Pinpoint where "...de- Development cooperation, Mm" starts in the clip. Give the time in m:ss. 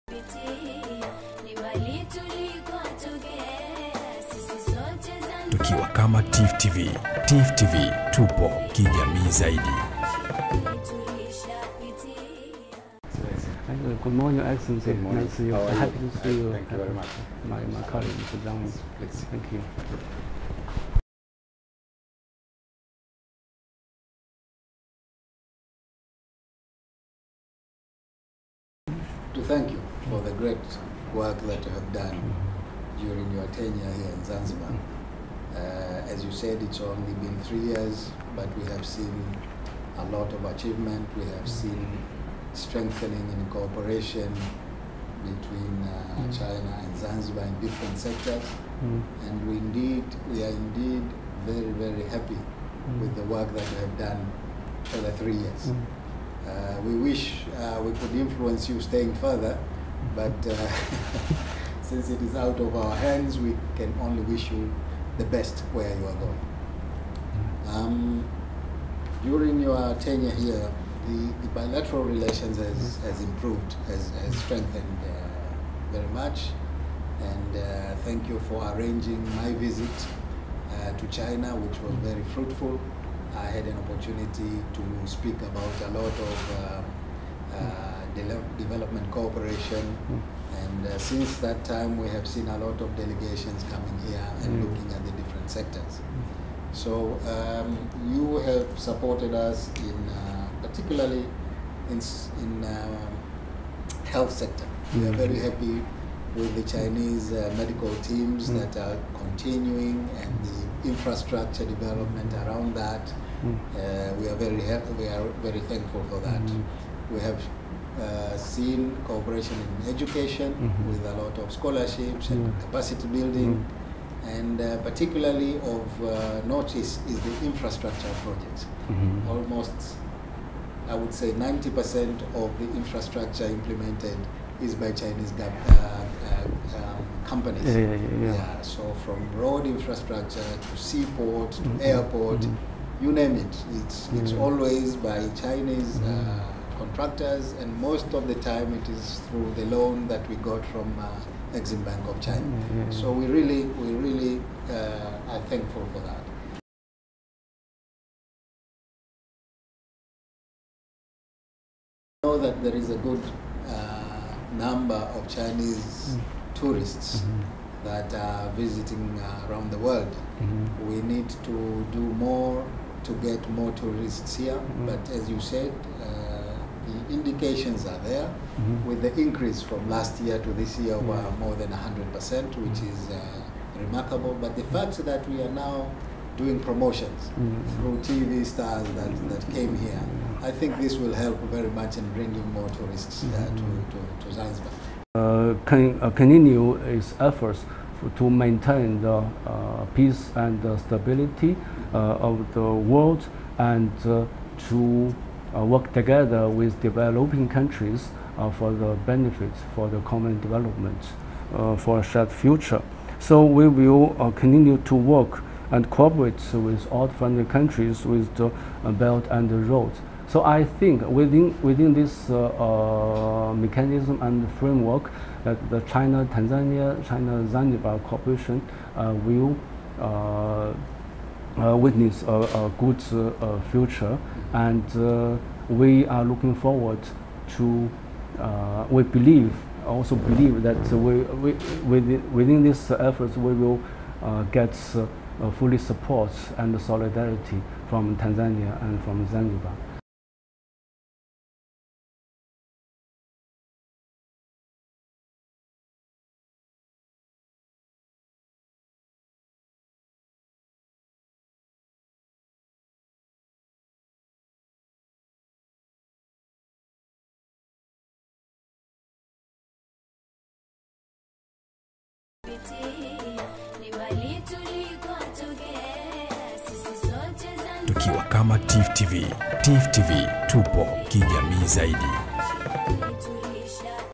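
1:28.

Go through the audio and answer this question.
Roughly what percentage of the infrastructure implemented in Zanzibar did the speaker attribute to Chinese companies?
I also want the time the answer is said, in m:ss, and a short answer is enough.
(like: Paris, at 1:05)
90%, at 2:11.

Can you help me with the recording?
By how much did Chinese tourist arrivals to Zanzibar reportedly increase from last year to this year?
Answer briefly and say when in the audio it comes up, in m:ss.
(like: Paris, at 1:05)
More than 100%, at 3:01.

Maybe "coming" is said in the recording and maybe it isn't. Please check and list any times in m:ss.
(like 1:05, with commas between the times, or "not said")
1:33.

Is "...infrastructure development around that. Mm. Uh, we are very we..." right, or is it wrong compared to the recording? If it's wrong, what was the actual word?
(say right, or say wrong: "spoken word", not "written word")
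right.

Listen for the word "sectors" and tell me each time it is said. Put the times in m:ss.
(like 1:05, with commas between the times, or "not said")
0:47, 1:35, 1:44.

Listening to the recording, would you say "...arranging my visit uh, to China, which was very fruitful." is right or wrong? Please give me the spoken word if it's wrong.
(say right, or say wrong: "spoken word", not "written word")
right.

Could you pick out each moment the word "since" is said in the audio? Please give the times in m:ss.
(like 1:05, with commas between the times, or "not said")
1:01, 1:30.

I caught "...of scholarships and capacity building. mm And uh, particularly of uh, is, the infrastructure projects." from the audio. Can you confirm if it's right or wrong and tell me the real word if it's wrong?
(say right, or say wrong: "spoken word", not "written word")
right.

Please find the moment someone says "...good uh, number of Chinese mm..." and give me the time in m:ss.
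2:43.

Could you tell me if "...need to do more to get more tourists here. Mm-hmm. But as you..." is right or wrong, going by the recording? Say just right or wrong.
right.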